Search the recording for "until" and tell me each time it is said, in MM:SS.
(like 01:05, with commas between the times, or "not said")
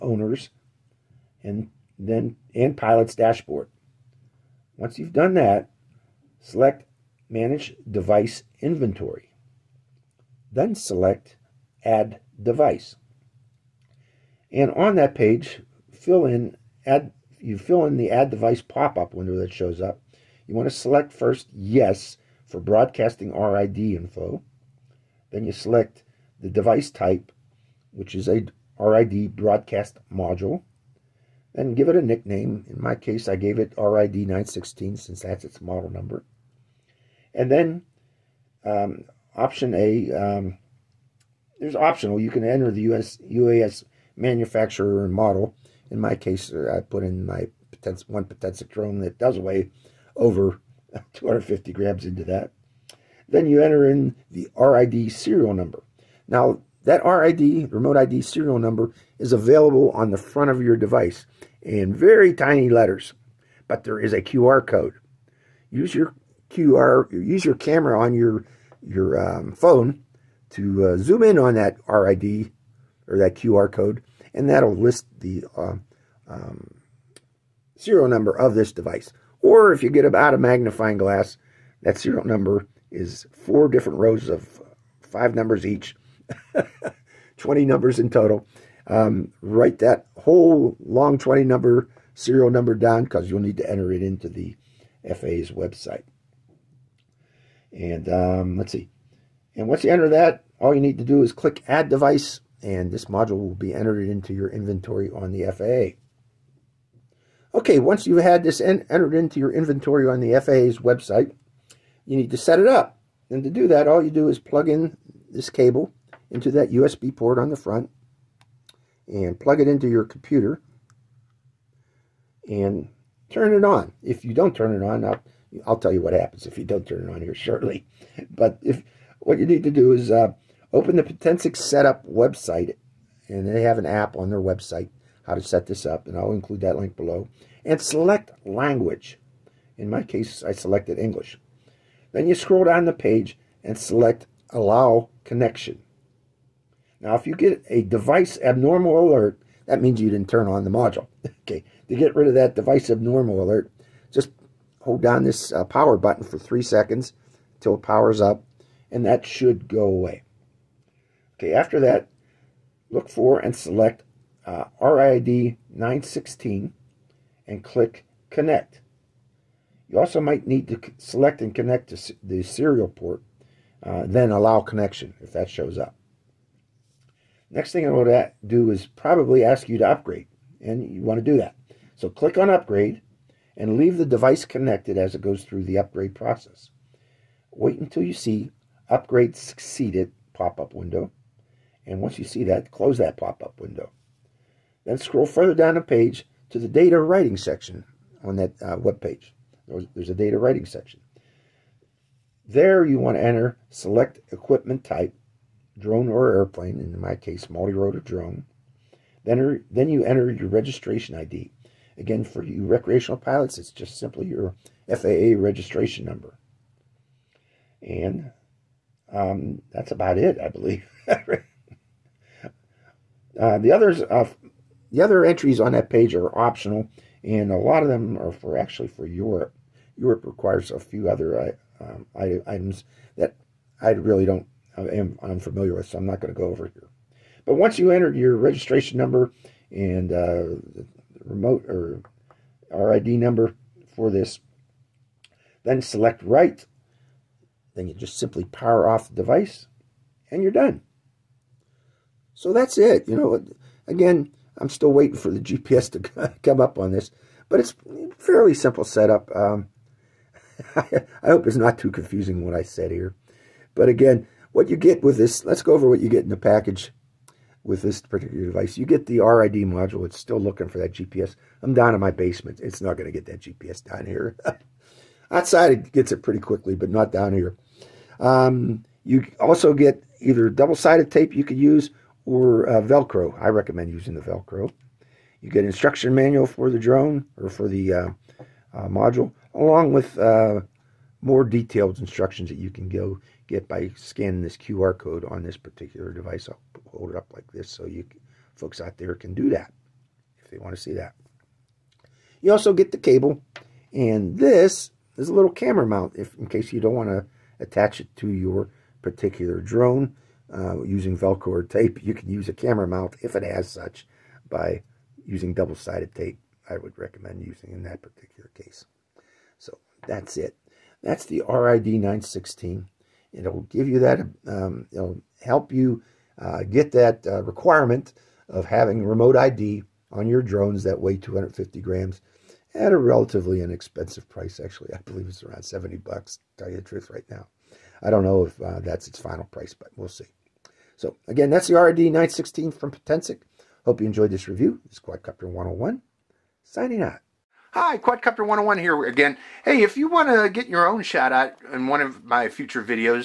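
02:37, 03:07.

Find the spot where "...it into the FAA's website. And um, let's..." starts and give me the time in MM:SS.
01:33.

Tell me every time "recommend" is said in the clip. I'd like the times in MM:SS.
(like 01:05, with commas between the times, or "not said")
04:43, 05:16.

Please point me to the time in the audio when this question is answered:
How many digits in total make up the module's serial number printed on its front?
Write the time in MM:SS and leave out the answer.
01:27.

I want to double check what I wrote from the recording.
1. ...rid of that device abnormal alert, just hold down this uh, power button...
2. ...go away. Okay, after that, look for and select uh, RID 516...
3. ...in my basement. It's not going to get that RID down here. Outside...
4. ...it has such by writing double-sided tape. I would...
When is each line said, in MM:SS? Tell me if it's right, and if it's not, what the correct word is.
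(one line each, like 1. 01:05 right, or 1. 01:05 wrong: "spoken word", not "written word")
1. 02:32 right
2. 02:39 wrong: "916", not "516"
3. 04:31 wrong: "GPS", not "RID"
4. 05:13 wrong: "using", not "writing".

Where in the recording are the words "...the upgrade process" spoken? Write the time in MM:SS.
03:05.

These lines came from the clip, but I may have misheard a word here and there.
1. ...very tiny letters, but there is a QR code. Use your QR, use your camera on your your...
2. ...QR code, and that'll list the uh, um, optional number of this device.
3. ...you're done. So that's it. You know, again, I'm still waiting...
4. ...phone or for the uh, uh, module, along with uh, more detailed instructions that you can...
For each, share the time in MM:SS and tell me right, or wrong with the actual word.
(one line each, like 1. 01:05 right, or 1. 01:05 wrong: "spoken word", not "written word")
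1. 01:01 right
2. 01:13 wrong: "serial", not "optional"
3. 04:10 right
4. 04:46 wrong: "drone", not "phone".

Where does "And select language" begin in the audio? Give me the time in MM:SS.
02:17.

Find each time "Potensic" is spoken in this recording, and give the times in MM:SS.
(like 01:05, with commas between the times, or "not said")
02:11, 05:42.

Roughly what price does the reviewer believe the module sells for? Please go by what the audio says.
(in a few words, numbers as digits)
$70.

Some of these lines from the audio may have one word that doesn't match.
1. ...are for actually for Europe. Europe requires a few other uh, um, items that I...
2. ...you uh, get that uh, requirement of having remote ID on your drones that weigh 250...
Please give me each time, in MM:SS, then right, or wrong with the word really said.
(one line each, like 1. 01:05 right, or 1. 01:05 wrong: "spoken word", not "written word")
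1. 03:48 right
2. 05:25 right.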